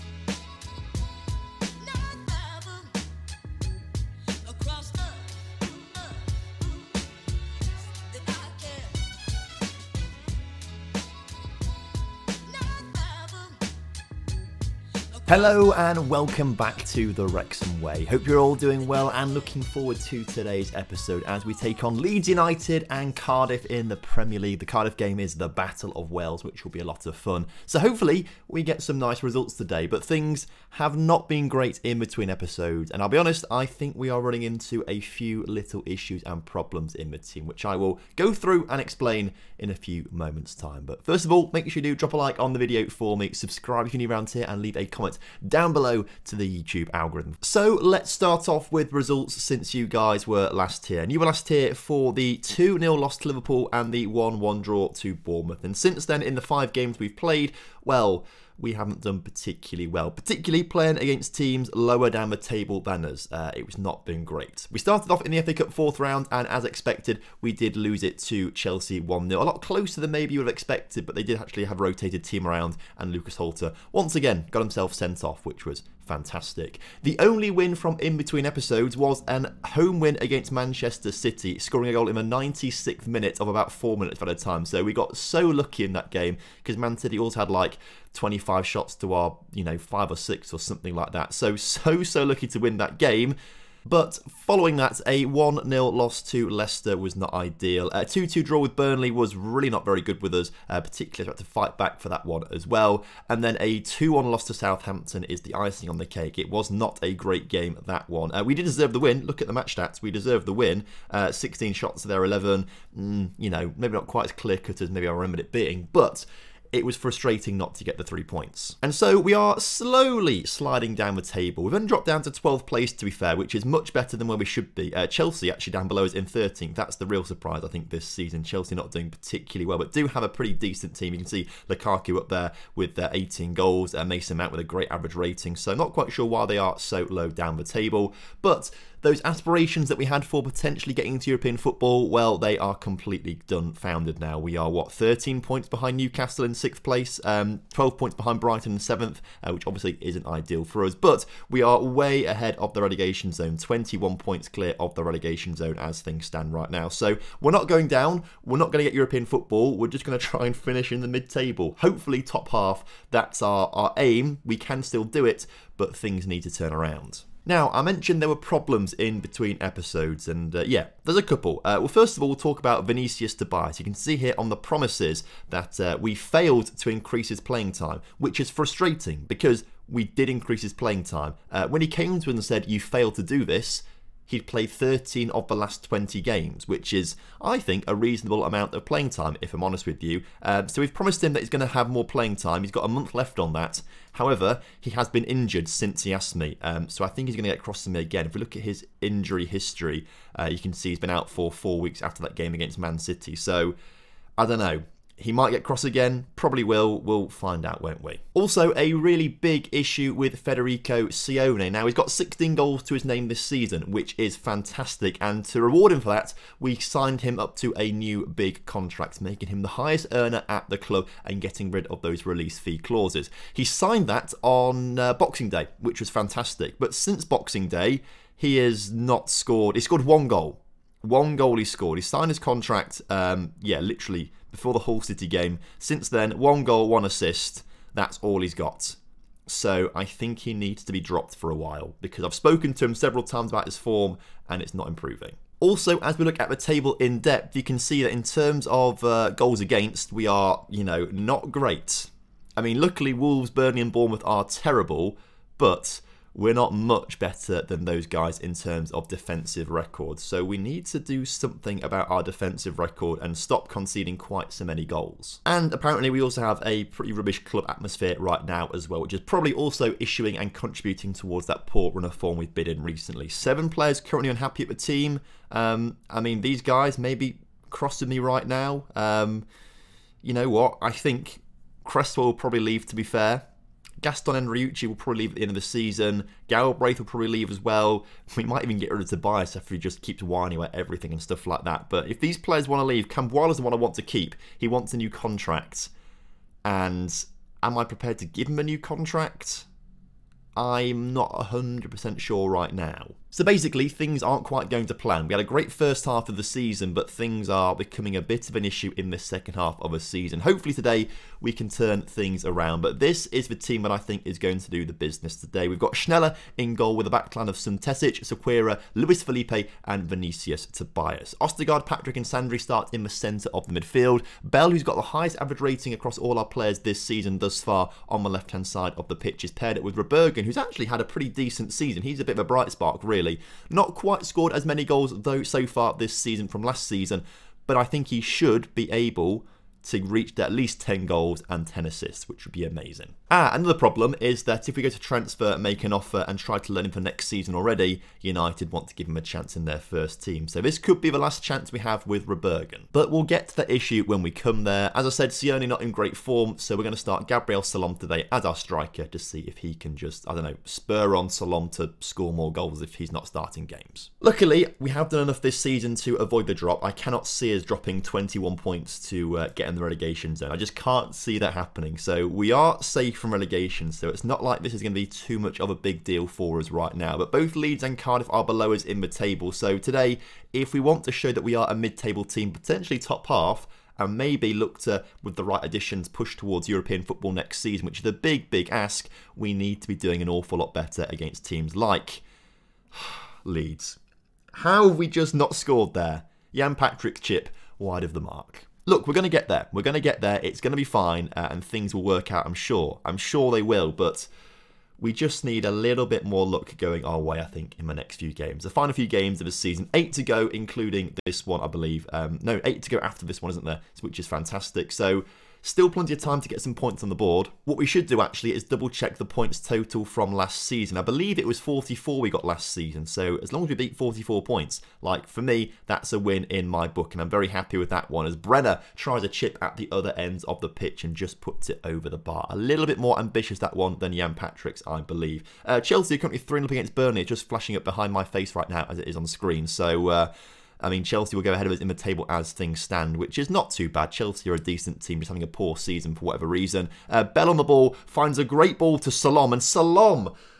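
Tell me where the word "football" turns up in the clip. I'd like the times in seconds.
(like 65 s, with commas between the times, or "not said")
141 s, 159 s, 387 s.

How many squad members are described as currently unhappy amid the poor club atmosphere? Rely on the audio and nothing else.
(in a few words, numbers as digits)
7.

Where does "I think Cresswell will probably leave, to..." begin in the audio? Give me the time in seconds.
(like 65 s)
280 s.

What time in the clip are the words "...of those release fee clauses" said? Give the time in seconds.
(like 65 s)
221 s.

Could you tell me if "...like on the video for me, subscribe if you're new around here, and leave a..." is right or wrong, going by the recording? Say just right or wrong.
right.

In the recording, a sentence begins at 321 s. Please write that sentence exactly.
Ostergaard, Patrick, and Sandri start in the centre of the midfield.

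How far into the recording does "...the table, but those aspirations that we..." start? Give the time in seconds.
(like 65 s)
137 s.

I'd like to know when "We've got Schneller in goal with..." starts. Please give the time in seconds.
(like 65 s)
315 s.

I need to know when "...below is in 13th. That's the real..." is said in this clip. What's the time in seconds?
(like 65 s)
125 s.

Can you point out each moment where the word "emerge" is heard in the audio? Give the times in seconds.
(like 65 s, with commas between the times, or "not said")
not said.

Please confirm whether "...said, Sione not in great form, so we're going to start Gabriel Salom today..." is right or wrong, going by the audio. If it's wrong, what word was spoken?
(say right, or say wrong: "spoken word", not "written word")
right.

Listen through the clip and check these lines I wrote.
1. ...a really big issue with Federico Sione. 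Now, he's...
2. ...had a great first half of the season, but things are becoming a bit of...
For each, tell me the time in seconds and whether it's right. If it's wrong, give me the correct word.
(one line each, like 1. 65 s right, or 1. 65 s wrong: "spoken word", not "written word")
1. 208 s right
2. 305 s right.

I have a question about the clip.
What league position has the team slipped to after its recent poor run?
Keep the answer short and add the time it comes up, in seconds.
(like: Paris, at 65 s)
12th, at 122 s.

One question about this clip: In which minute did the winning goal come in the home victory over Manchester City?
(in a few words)
96th.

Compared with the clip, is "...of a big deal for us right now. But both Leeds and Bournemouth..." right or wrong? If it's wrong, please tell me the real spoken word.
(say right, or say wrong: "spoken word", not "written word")
wrong: "Cardiff", not "Bournemouth".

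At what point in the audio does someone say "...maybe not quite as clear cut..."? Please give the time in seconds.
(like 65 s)
113 s.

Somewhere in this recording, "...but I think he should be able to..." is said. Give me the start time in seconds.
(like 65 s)
337 s.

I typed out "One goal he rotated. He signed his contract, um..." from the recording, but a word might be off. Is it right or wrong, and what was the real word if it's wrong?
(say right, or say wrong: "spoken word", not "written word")
wrong: "scored", not "rotated".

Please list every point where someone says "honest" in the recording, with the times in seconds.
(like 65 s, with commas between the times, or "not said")
33 s, 189 s.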